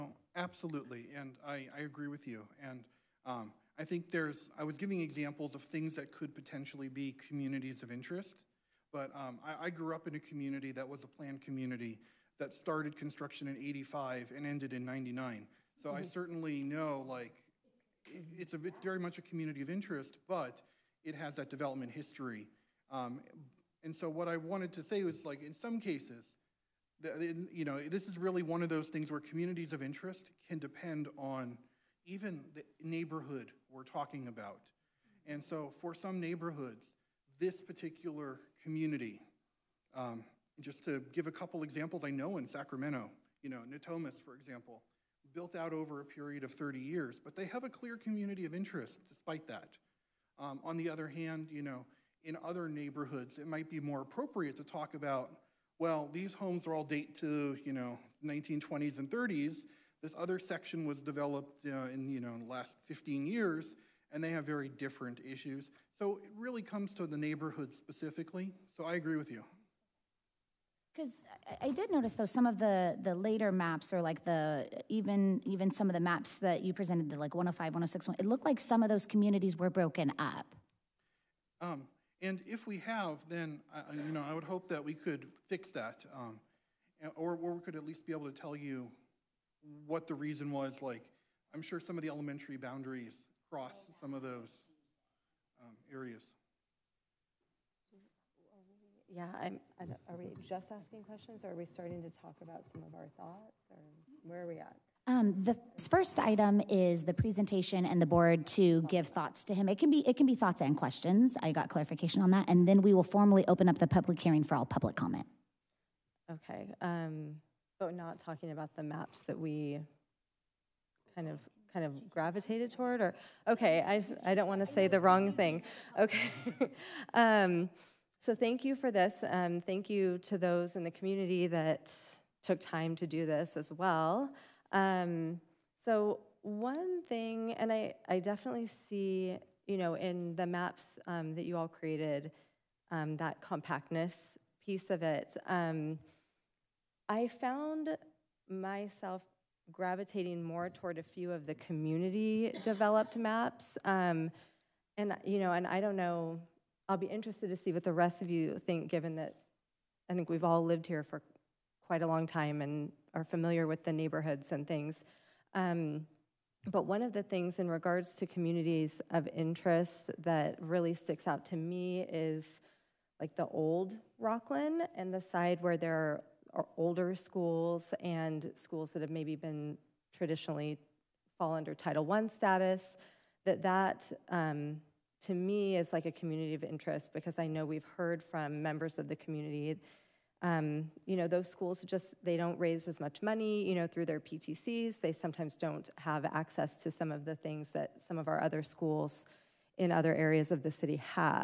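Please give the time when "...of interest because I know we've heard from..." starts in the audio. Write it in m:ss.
3:06.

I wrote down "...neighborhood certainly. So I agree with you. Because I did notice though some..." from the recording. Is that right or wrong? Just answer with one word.
wrong.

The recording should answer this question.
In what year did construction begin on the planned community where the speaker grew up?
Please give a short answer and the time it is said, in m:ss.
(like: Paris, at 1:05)
1985, at 0:13.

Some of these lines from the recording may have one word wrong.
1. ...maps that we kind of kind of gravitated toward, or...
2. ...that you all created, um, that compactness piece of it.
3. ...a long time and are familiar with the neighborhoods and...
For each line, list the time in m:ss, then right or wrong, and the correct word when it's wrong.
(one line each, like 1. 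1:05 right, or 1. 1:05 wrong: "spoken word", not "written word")
1. 1:58 right
2. 2:21 right
3. 2:42 right.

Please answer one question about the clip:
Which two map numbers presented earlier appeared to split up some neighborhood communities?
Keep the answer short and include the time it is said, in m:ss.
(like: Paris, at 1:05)
105 and 106, at 1:17.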